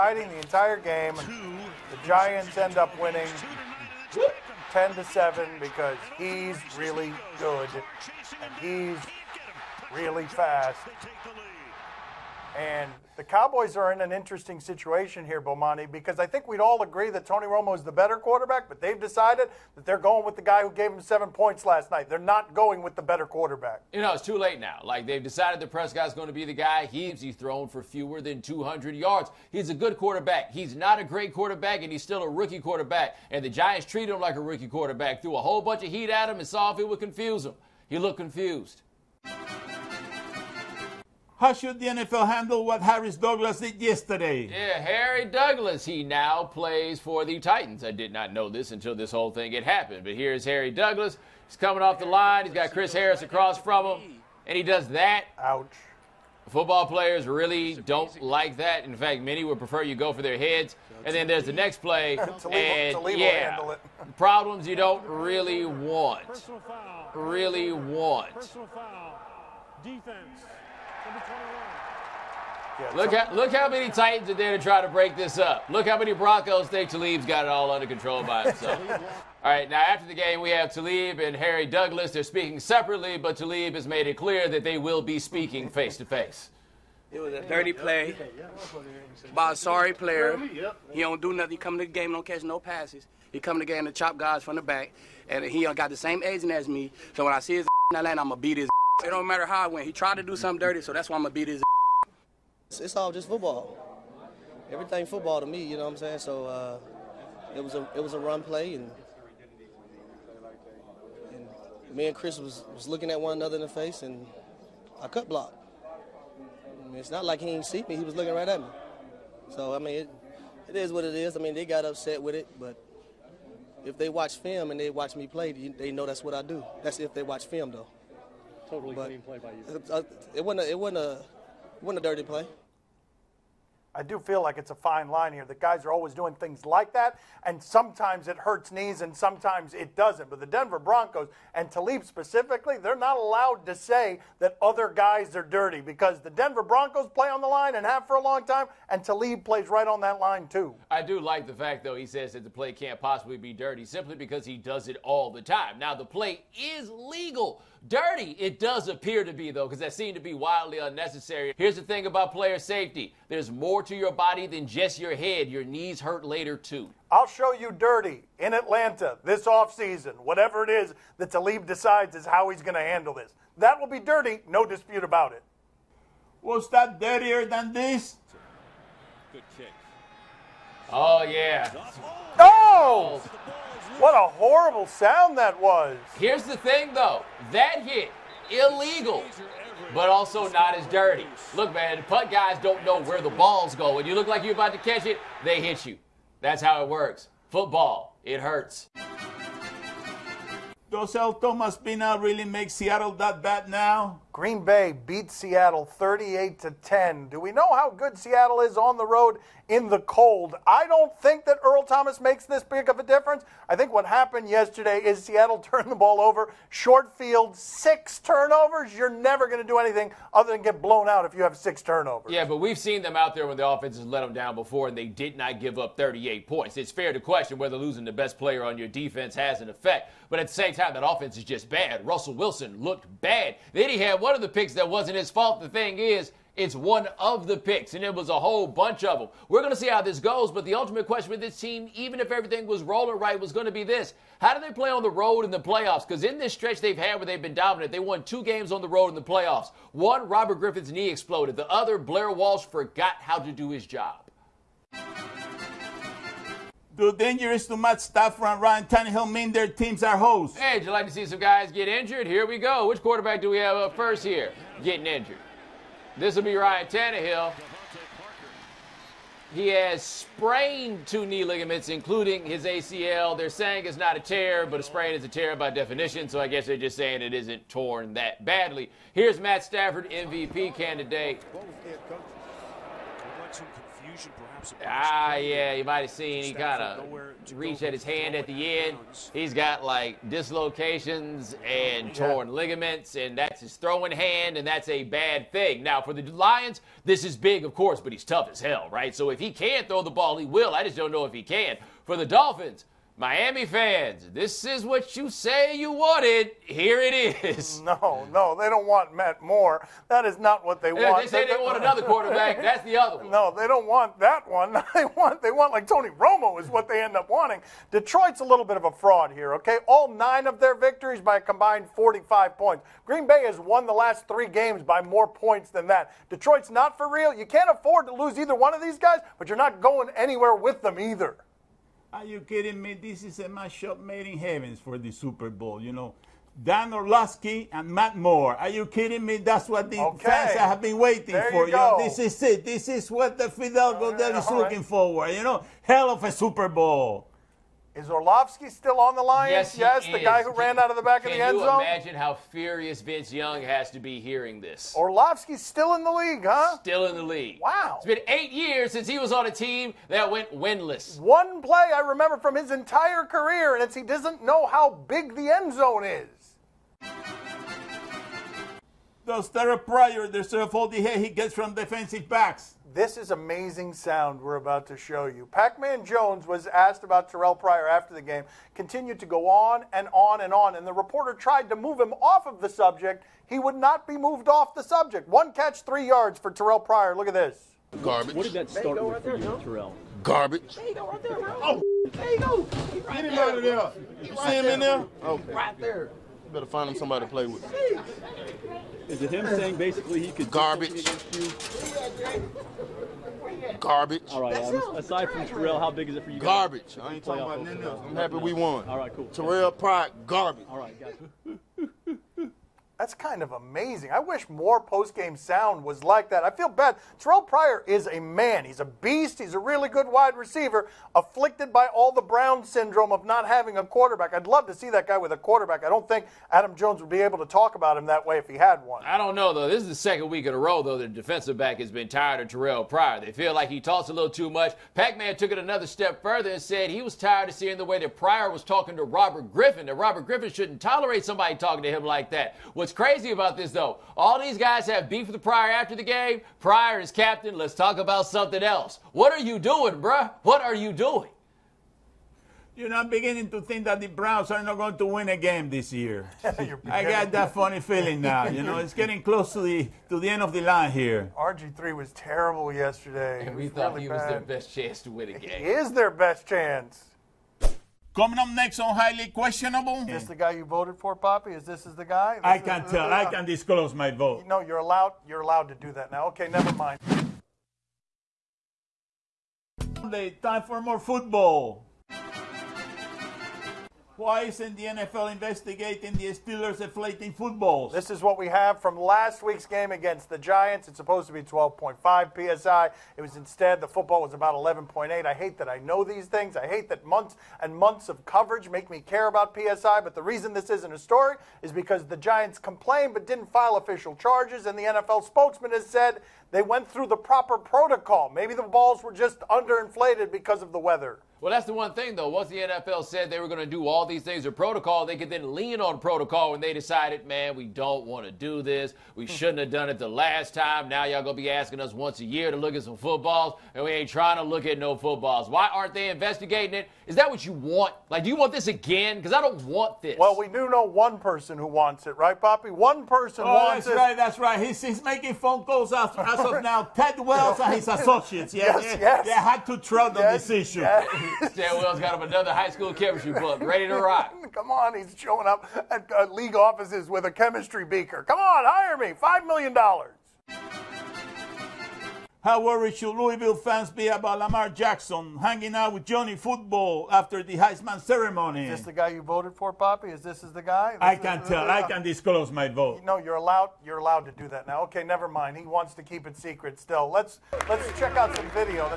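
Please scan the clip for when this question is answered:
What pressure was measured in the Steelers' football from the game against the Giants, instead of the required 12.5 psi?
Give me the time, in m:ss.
8:14.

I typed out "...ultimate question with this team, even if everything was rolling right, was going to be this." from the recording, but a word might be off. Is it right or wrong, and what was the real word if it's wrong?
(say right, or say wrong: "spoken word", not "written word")
right.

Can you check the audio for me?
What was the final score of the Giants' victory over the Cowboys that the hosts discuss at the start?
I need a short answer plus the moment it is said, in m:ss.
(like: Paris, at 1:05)
10 to 7, at 0:04.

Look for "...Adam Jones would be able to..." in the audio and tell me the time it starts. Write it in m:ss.
7:06.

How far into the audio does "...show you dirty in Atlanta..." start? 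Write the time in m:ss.
2:47.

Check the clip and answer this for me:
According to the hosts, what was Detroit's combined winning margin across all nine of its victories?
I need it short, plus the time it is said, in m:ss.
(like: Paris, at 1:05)
45, at 5:21.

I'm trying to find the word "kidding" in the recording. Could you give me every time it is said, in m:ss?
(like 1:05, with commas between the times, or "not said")
5:32, 5:38.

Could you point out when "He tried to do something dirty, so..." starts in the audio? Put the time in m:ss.
1:39.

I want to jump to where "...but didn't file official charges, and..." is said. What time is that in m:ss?
8:23.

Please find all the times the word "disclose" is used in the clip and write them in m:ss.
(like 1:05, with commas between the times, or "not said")
7:53, 9:22.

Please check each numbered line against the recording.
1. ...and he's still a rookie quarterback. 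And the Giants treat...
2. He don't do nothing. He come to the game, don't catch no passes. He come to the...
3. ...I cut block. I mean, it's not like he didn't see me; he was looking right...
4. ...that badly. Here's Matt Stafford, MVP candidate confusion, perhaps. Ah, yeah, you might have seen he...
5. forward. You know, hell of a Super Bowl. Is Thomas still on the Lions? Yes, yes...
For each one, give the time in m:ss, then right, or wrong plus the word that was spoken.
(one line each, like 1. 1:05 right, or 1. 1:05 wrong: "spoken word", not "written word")
1. 0:31 right
2. 1:30 right
3. 1:55 right
4. 4:38 right
5. 5:44 wrong: "Orlovsky", not "Thomas".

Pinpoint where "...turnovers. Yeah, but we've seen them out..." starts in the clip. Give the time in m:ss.
3:41.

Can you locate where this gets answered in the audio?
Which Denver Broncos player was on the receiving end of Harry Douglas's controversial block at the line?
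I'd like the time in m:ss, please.
0:52.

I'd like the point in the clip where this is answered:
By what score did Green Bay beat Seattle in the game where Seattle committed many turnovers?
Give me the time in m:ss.
3:25.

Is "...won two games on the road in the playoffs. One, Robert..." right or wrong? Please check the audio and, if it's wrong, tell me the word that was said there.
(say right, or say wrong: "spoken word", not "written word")
right.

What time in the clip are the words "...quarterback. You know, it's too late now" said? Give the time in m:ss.
0:23.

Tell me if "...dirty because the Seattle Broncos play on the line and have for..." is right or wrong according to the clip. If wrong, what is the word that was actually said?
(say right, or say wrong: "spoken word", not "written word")
wrong: "Denver", not "Seattle".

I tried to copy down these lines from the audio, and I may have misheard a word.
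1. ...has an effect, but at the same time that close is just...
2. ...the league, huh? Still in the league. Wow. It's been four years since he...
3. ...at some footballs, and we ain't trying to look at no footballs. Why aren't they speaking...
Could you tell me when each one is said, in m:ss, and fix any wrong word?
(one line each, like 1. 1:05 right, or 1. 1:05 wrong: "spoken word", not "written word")
1. 3:49 wrong: "offense", not "close"
2. 5:56 wrong: "eight", not "four"
3. 8:42 wrong: "investigating", not "speaking".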